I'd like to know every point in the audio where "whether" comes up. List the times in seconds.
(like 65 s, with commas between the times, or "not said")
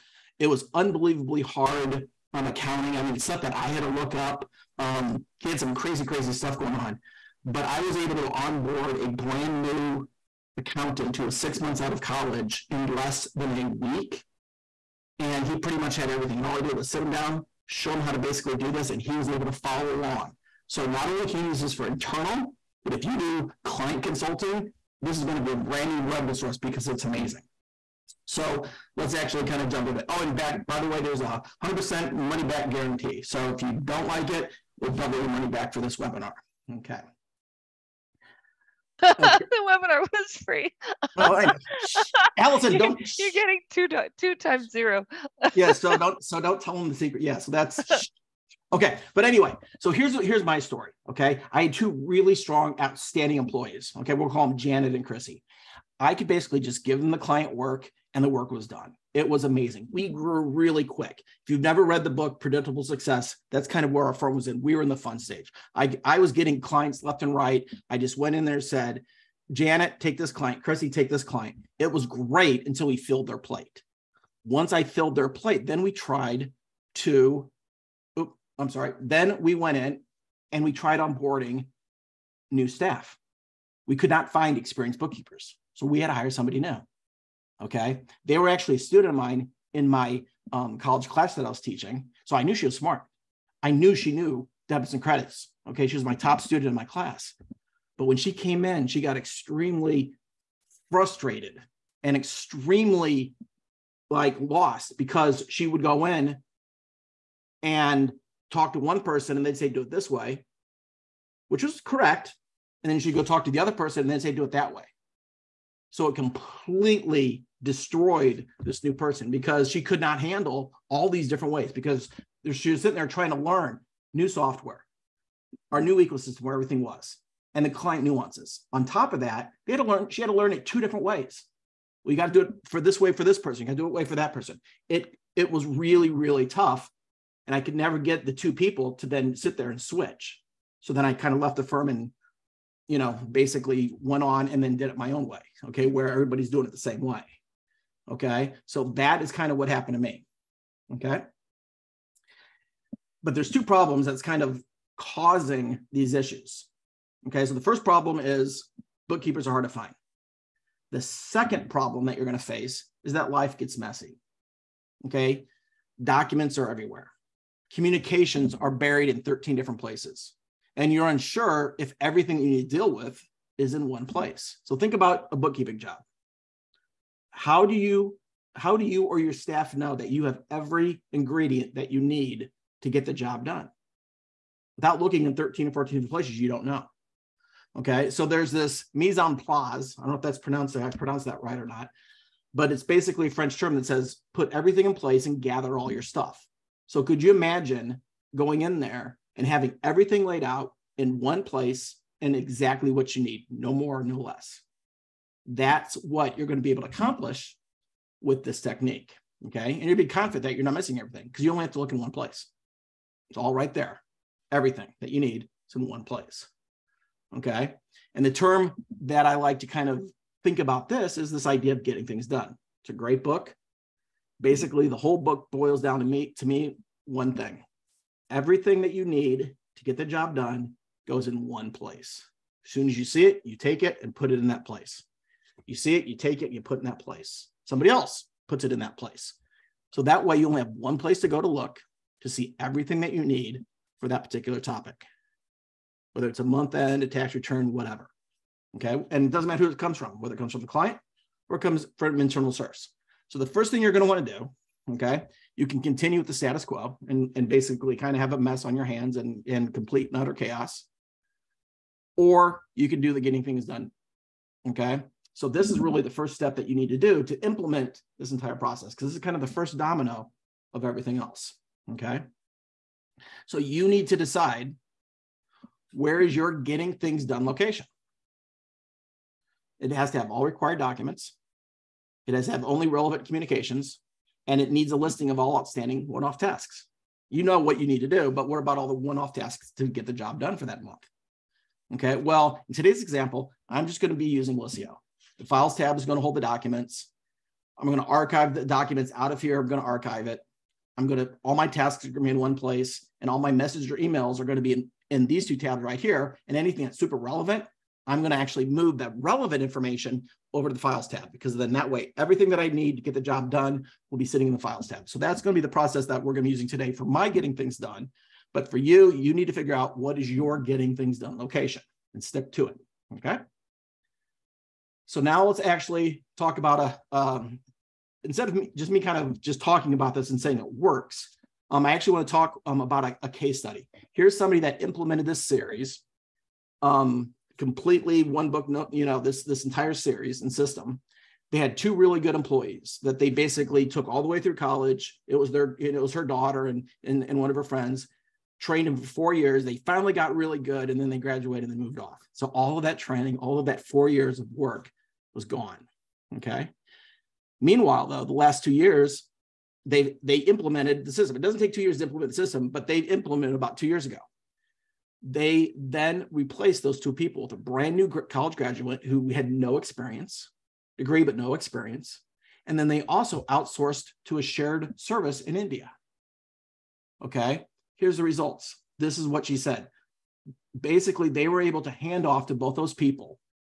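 246 s, 250 s.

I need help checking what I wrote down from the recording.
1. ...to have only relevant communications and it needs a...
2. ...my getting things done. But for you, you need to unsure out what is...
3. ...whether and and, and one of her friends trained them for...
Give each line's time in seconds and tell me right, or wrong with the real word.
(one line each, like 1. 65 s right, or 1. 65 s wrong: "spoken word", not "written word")
1. 282 s right
2. 317 s wrong: "figure", not "unsure"
3. 346 s wrong: "daughter", not "whether".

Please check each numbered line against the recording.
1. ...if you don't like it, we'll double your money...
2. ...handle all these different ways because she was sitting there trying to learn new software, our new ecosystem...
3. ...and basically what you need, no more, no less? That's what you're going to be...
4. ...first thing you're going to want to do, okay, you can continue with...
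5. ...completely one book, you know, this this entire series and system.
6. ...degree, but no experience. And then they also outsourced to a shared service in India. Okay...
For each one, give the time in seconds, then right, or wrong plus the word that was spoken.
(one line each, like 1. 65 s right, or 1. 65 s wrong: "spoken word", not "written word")
1. 33 s right
2. 120 s right
3. 202 s wrong: "exactly", not "basically"
4. 253 s right
5. 337 s right
6. 370 s right.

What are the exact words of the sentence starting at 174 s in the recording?
So think about a bookkeeping job.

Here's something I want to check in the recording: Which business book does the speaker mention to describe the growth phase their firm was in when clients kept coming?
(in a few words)
Predictable Success.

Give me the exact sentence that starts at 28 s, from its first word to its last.
So let's actually kind of jump into it.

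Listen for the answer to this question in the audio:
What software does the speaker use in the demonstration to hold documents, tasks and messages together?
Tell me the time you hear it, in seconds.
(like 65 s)
294 s.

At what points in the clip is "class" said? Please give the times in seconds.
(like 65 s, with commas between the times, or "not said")
91 s, 96 s.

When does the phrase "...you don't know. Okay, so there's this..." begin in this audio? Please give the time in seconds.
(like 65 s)
186 s.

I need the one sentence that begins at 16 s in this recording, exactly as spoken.
And all I did was sit him down, show him how to basically do this, and he was able to follow along.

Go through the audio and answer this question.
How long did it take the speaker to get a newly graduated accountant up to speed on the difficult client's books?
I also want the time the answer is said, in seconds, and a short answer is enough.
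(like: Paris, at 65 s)
less than a week, at 12 s.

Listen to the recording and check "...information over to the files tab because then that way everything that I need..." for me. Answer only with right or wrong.
right.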